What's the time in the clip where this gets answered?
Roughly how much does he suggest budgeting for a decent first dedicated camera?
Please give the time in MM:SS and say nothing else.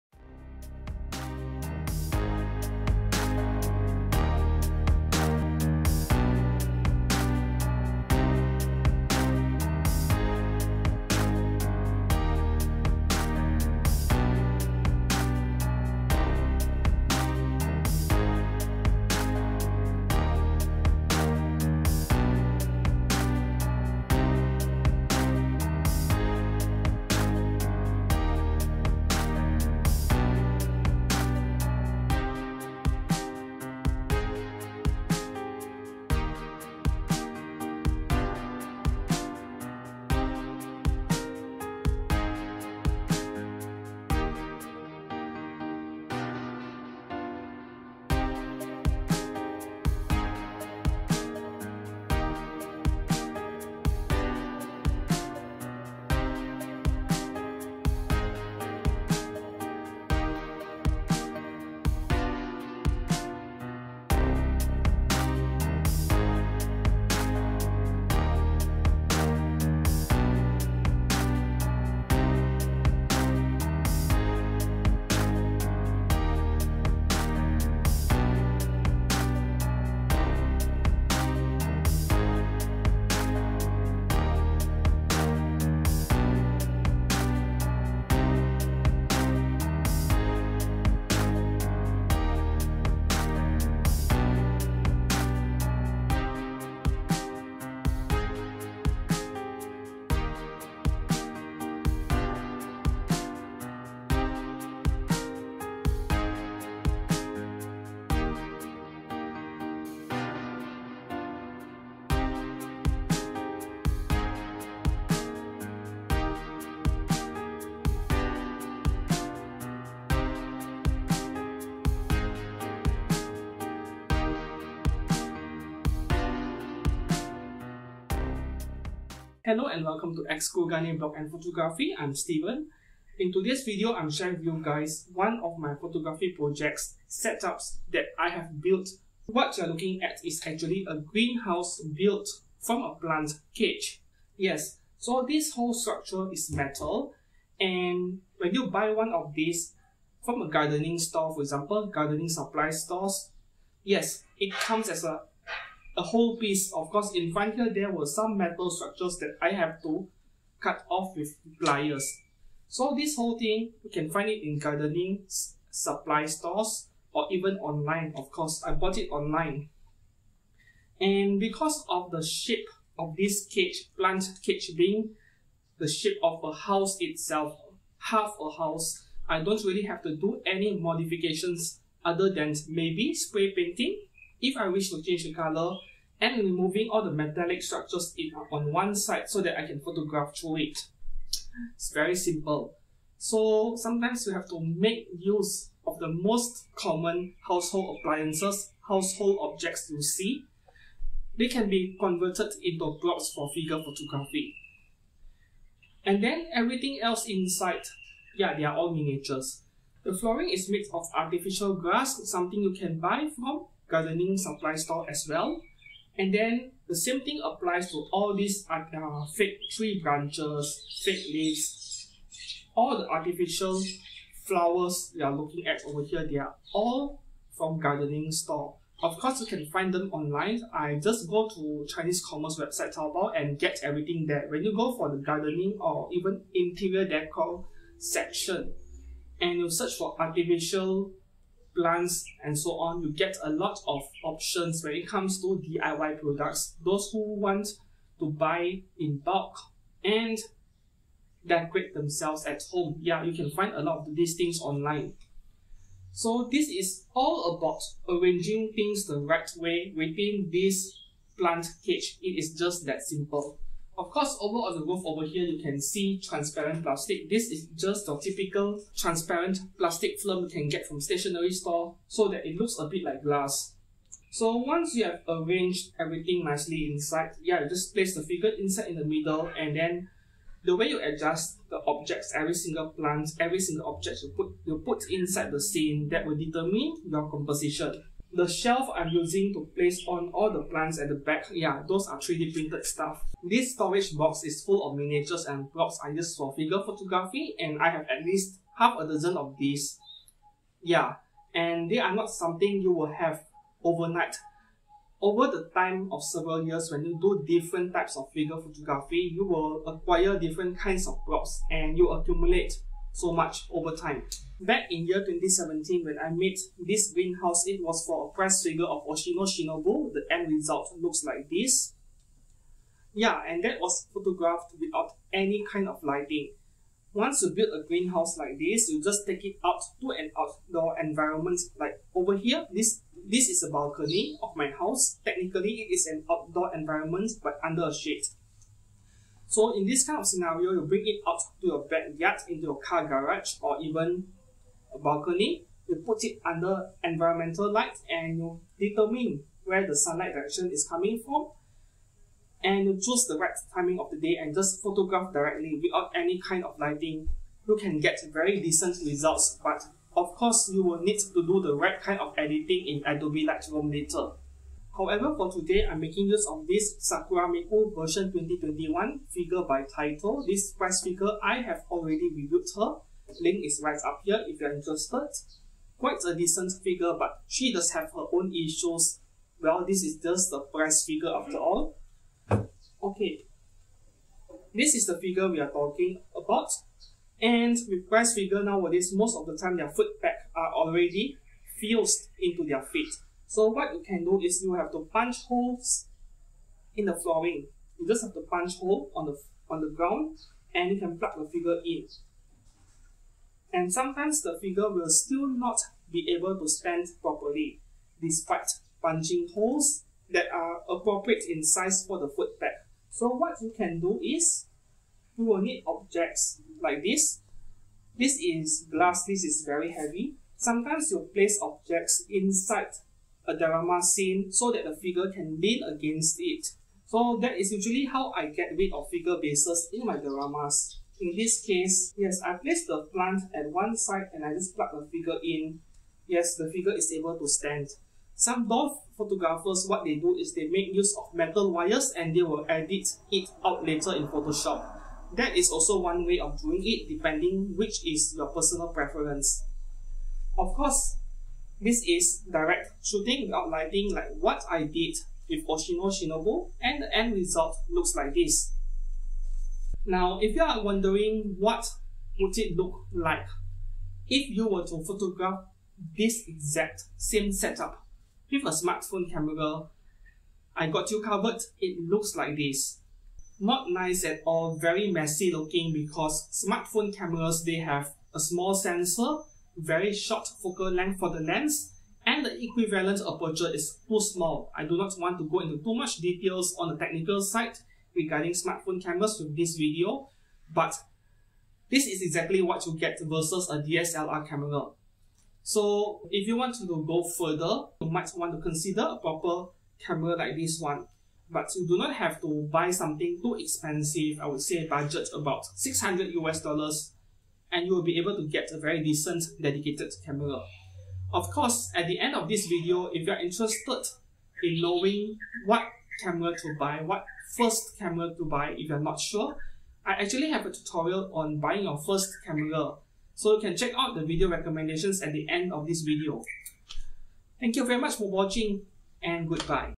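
08:25.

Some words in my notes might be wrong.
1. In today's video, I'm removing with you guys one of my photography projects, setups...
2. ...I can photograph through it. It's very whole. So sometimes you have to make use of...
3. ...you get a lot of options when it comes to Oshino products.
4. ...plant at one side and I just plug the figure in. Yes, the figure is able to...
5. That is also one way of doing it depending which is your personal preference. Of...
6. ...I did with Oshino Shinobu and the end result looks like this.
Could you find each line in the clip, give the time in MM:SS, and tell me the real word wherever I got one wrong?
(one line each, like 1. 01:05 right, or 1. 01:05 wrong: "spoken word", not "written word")
1. 02:13 wrong: "sharing", not "removing"
2. 03:09 wrong: "simple", not "whole"
3. 04:03 wrong: "DIY", not "Oshino"
4. 07:13 right
5. 07:25 right
6. 07:34 right.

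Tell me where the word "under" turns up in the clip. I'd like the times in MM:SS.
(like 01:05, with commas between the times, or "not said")
05:37, 05:46.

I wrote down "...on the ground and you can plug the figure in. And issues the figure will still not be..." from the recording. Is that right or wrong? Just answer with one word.
wrong.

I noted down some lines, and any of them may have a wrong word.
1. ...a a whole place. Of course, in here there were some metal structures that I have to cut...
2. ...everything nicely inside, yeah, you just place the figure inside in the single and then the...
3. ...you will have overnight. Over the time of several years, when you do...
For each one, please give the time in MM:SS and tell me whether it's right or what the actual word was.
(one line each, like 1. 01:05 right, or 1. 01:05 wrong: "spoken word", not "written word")
1. 02:35 wrong: "piece", not "place"
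2. 04:35 wrong: "middle", not "single"
3. 05:02 right.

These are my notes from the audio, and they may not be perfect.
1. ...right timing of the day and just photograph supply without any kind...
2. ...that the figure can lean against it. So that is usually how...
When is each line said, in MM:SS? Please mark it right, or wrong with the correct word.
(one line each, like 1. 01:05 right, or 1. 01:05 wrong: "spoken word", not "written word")
1. 05:53 wrong: "directly", not "supply"
2. 07:04 right.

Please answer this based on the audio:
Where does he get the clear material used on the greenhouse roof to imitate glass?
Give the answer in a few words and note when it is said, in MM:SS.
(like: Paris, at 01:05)
Stationery store, at 04:31.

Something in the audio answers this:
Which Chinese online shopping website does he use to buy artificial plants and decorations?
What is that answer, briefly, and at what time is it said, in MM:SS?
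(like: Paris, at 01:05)
Taobao, at 03:52.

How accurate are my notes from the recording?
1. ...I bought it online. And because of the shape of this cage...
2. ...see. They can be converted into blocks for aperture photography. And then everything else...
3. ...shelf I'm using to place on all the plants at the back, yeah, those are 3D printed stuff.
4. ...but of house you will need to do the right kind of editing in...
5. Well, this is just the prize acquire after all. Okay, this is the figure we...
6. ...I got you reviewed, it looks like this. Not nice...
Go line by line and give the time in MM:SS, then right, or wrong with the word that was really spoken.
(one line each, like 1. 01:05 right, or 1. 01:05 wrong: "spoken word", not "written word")
1. 02:48 right
2. 03:20 wrong: "figure", not "aperture"
3. 04:48 right
4. 05:59 wrong: "course", not "house"
5. 06:19 wrong: "figure", not "acquire"
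6. 07:50 wrong: "covered", not "reviewed".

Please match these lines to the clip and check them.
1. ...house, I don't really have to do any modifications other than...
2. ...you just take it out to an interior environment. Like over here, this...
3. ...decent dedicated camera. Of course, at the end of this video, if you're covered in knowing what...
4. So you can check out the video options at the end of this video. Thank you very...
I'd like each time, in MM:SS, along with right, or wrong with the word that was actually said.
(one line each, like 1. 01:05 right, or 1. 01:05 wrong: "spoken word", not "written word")
1. 02:58 right
2. 05:28 wrong: "outdoor", not "interior"
3. 08:29 wrong: "interested", not "covered"
4. 08:43 wrong: "recommendations", not "options".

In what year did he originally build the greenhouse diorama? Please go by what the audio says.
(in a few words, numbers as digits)
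2017.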